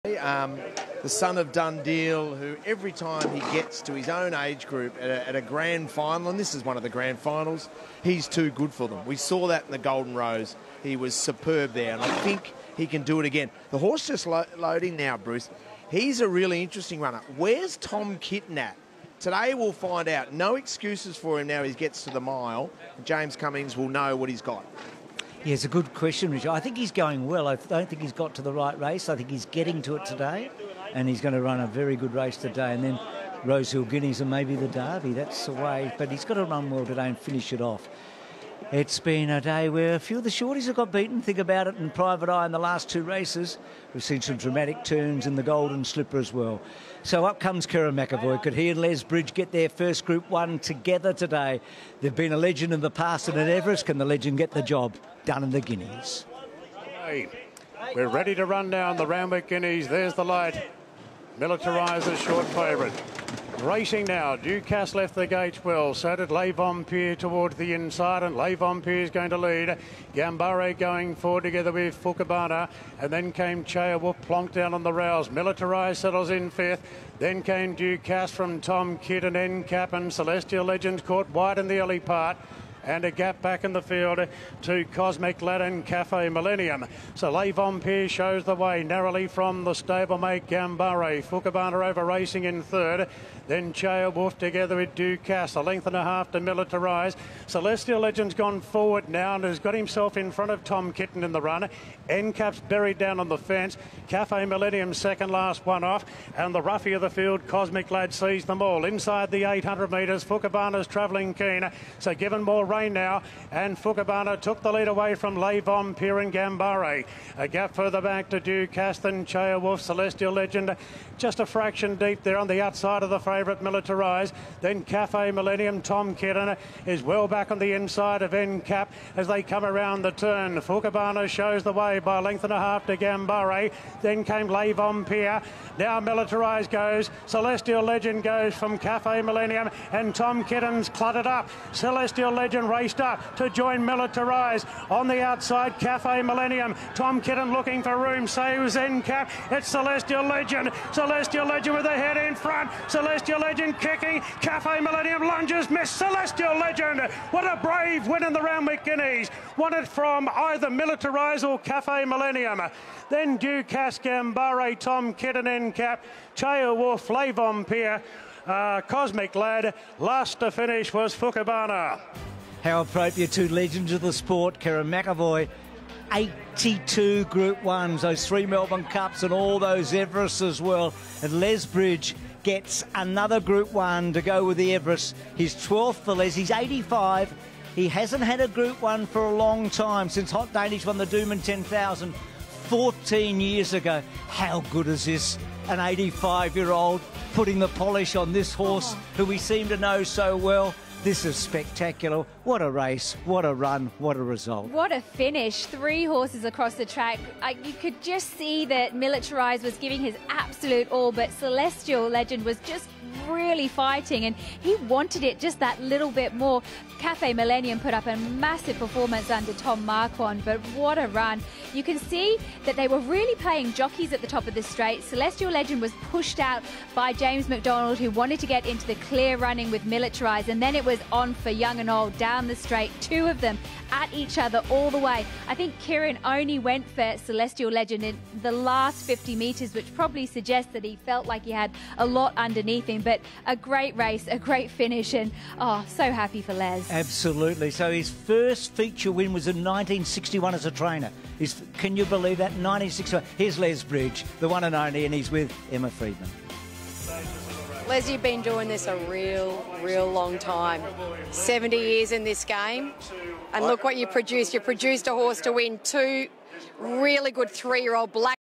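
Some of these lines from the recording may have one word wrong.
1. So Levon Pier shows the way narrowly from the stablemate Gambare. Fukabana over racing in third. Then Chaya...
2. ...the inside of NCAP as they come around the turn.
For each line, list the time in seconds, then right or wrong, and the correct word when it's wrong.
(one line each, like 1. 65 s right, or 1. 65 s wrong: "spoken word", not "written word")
1. 87 s right
2. 127 s right.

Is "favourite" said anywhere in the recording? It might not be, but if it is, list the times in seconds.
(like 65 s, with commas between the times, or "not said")
62 s, 123 s.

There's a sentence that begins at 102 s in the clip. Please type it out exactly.
Endcap's buried down on the fence.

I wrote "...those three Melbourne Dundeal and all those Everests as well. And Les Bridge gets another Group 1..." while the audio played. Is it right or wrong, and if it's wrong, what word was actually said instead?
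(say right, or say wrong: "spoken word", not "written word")
wrong: "Cups", not "Dundeal".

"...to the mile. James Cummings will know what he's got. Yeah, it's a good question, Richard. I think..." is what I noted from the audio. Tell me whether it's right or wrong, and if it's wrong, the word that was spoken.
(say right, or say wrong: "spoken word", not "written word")
right.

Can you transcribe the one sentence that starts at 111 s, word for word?
So given more rain now, and Fukabana took the lead away from Levom Piran Gambare.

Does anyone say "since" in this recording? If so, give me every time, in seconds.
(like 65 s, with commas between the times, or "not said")
190 s.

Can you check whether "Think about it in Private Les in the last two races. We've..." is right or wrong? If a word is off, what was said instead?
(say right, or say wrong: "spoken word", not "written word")
wrong: "Eye", not "Les".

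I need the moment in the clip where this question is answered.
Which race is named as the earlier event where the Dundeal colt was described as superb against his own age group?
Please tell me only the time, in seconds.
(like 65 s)
9 s.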